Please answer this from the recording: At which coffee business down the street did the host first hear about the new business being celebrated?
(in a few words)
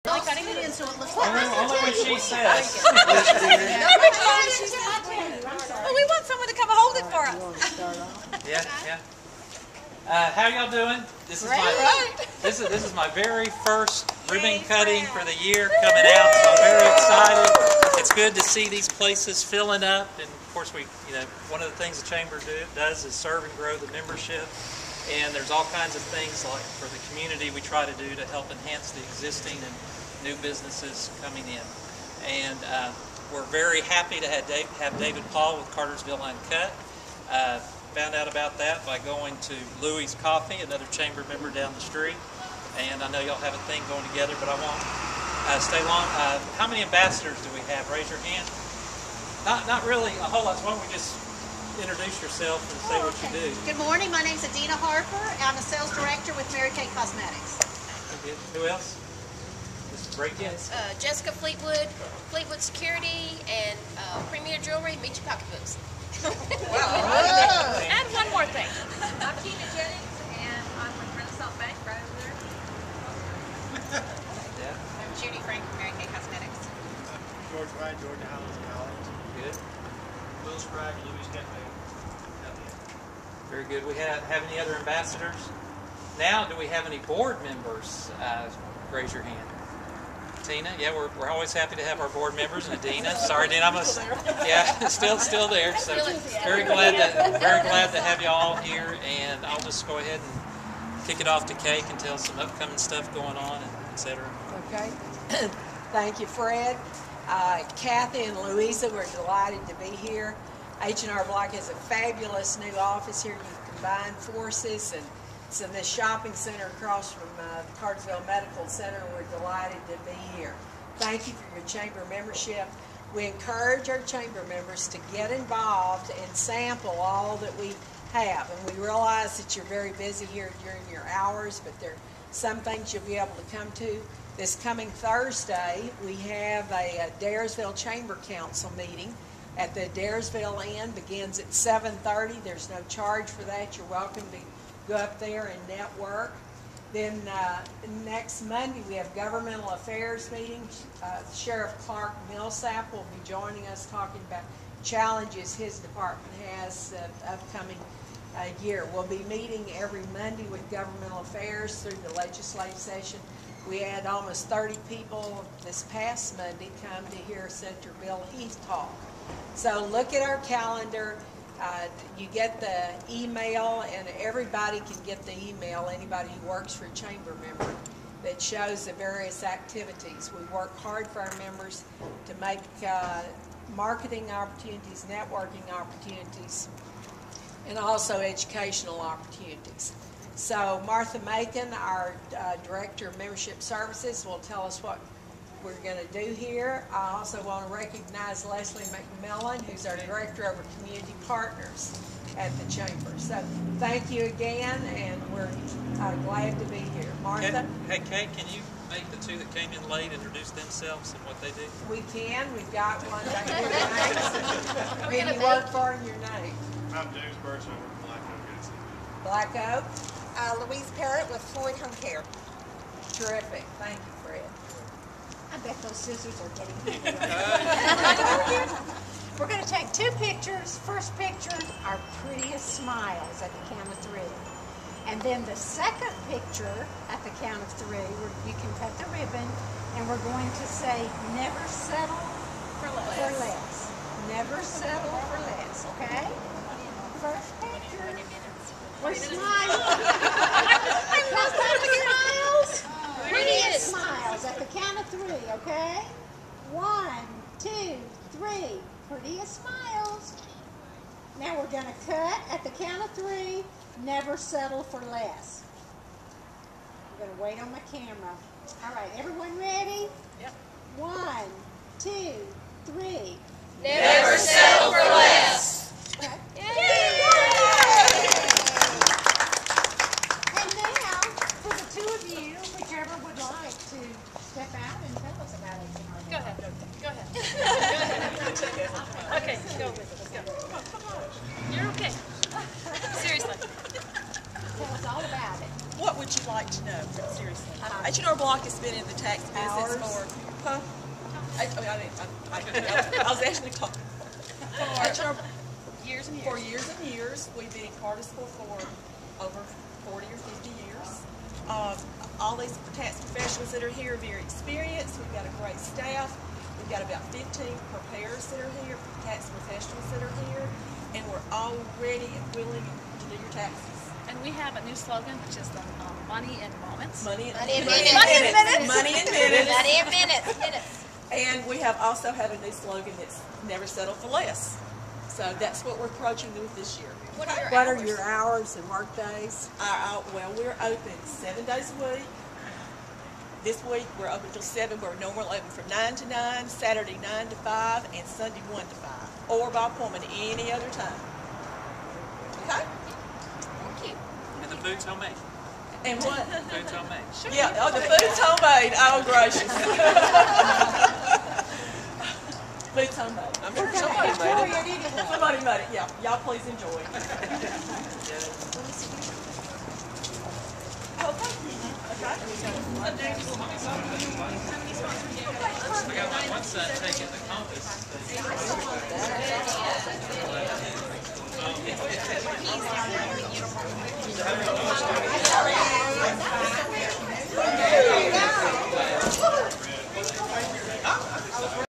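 Louie's Coffee.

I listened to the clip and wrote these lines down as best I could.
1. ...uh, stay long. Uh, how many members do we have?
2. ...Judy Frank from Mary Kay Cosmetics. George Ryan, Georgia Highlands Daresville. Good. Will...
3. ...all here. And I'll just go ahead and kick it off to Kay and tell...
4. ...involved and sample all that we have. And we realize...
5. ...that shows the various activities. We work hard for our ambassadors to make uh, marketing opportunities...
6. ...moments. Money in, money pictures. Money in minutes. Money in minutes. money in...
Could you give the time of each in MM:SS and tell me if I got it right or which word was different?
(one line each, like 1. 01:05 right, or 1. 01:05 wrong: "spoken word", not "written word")
1. 00:45 wrong: "ambassadors", not "members"
2. 01:15 wrong: "College", not "Daresville"
3. 01:38 right
4. 02:05 right
5. 02:58 wrong: "members", not "ambassadors"
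6. 05:26 wrong: "minutes", not "pictures".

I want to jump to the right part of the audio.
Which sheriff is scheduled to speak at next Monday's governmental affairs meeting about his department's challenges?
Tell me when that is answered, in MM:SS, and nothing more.
02:31.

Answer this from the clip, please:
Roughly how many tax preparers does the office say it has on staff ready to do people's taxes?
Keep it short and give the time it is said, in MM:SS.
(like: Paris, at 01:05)
15, at 05:17.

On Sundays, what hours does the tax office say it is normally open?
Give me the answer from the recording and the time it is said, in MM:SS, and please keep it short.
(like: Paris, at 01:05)
1 to 5, at 05:48.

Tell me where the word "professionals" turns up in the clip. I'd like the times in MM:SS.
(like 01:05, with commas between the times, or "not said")
05:13, 05:19.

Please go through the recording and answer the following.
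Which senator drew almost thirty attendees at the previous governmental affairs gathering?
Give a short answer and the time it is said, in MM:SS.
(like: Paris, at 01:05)
Bill Heath, at 02:48.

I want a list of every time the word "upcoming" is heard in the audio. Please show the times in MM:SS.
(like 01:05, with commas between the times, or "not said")
01:42, 02:37.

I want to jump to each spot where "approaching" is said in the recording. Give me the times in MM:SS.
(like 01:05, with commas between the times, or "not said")
05:36.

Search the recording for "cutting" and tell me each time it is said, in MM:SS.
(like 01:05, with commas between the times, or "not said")
00:14.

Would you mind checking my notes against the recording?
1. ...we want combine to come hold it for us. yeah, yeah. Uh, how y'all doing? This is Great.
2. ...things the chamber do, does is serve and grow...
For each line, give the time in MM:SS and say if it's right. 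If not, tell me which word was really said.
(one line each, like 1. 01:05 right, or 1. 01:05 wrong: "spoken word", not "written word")
1. 00:05 wrong: "someone", not "combine"
2. 00:21 right.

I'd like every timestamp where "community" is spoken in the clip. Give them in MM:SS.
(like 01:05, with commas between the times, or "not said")
00:27, 03:20.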